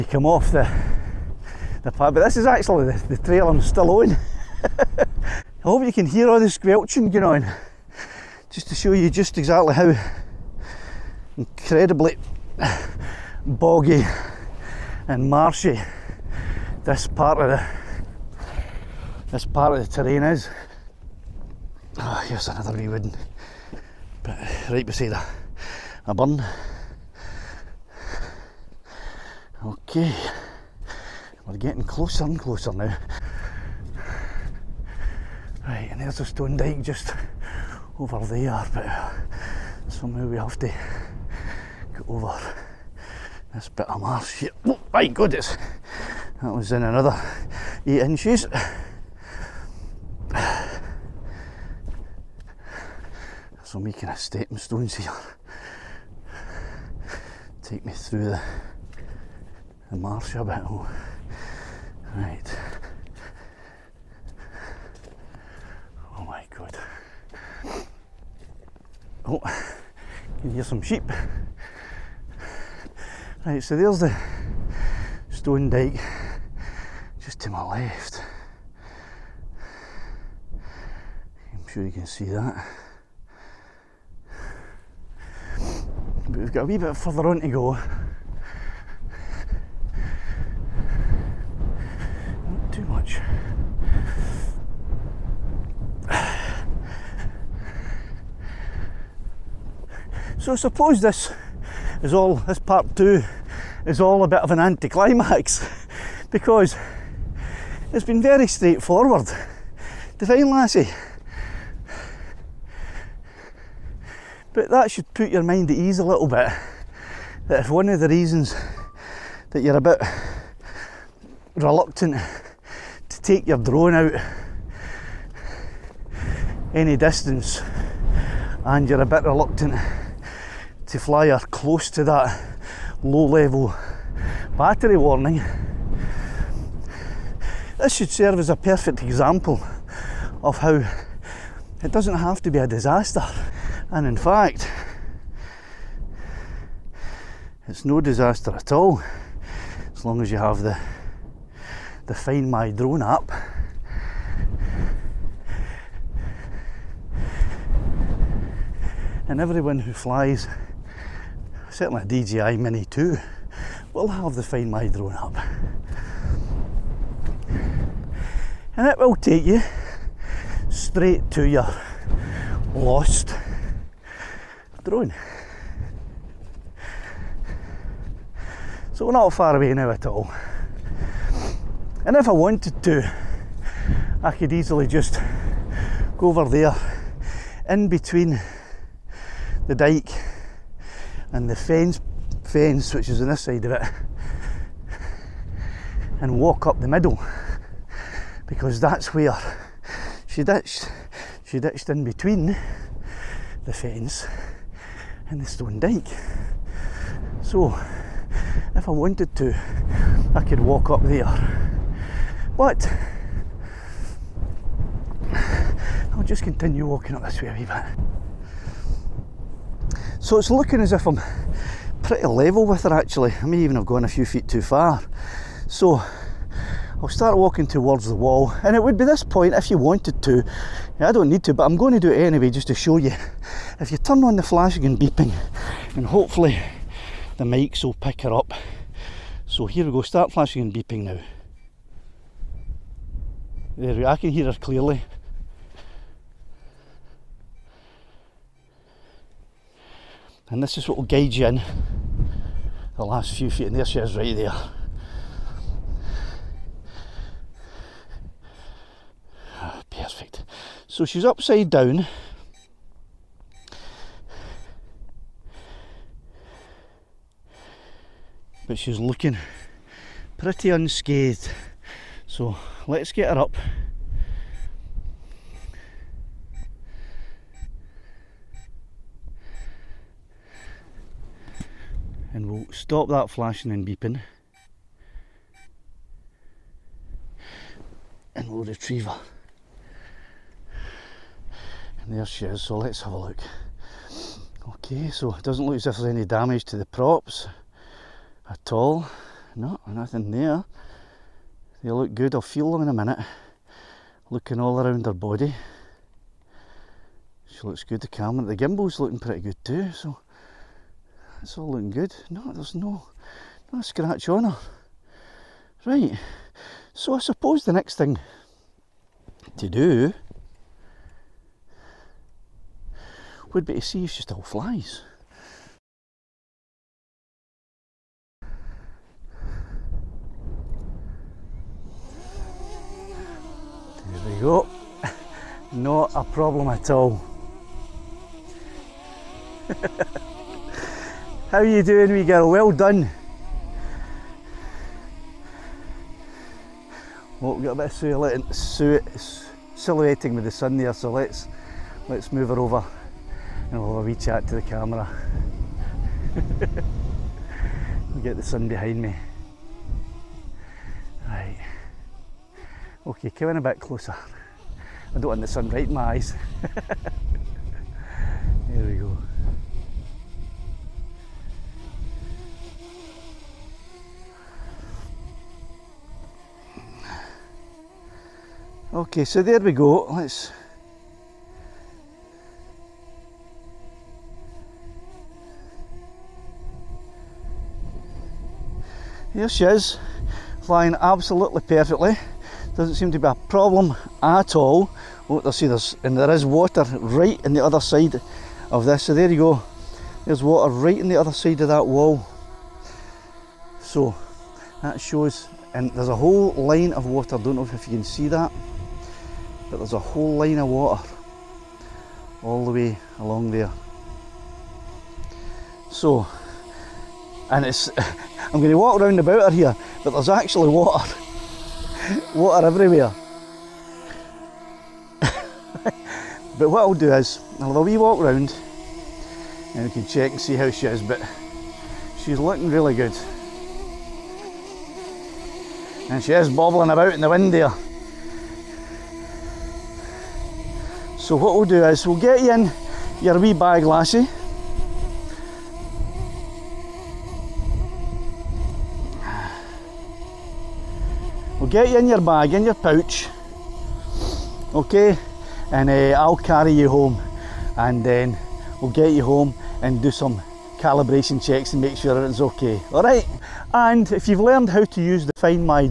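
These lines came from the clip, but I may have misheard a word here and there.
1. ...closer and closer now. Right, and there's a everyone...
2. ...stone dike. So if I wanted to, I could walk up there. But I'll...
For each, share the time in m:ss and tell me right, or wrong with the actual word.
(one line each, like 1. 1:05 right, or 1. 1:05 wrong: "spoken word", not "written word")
1. 0:31 wrong: "stone", not "everyone"
2. 3:25 right.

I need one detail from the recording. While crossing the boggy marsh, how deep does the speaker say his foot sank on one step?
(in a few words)
8 inches.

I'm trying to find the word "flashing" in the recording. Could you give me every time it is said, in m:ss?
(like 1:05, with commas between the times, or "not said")
3:54, 4:00, 4:43.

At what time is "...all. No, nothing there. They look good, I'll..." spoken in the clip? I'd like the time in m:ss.
4:58.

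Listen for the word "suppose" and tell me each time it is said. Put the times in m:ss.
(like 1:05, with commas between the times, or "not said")
1:40, 5:17.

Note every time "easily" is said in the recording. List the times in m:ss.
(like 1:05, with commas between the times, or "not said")
3:04.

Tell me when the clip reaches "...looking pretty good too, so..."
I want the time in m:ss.
5:08.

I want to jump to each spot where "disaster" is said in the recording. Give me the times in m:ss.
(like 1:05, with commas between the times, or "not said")
2:22, 2:28.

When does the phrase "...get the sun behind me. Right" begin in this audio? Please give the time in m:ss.
5:58.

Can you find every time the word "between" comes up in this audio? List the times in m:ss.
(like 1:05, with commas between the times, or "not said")
3:07, 3:22.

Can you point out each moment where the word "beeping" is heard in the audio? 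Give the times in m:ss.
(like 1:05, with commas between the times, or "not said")
3:54, 4:00, 4:43.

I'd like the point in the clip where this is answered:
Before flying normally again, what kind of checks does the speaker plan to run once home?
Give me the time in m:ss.
7:40.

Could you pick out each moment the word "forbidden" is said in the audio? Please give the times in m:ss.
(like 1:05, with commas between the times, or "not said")
not said.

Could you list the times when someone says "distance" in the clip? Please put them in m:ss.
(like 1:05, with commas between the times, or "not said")
2:06.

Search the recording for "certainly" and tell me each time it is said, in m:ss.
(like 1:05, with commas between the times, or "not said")
2:41.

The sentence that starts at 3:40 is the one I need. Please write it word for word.
So it's looking as if I'm pretty level with her actually.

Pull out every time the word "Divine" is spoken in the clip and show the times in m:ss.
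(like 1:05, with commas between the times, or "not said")
1:50.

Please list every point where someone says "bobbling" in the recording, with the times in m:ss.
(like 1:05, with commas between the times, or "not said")
7:16.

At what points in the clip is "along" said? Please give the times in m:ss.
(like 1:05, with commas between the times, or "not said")
6:53.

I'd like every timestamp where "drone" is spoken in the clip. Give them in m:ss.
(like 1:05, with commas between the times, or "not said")
2:03, 2:32, 2:44, 2:54.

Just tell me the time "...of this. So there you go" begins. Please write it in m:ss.
6:38.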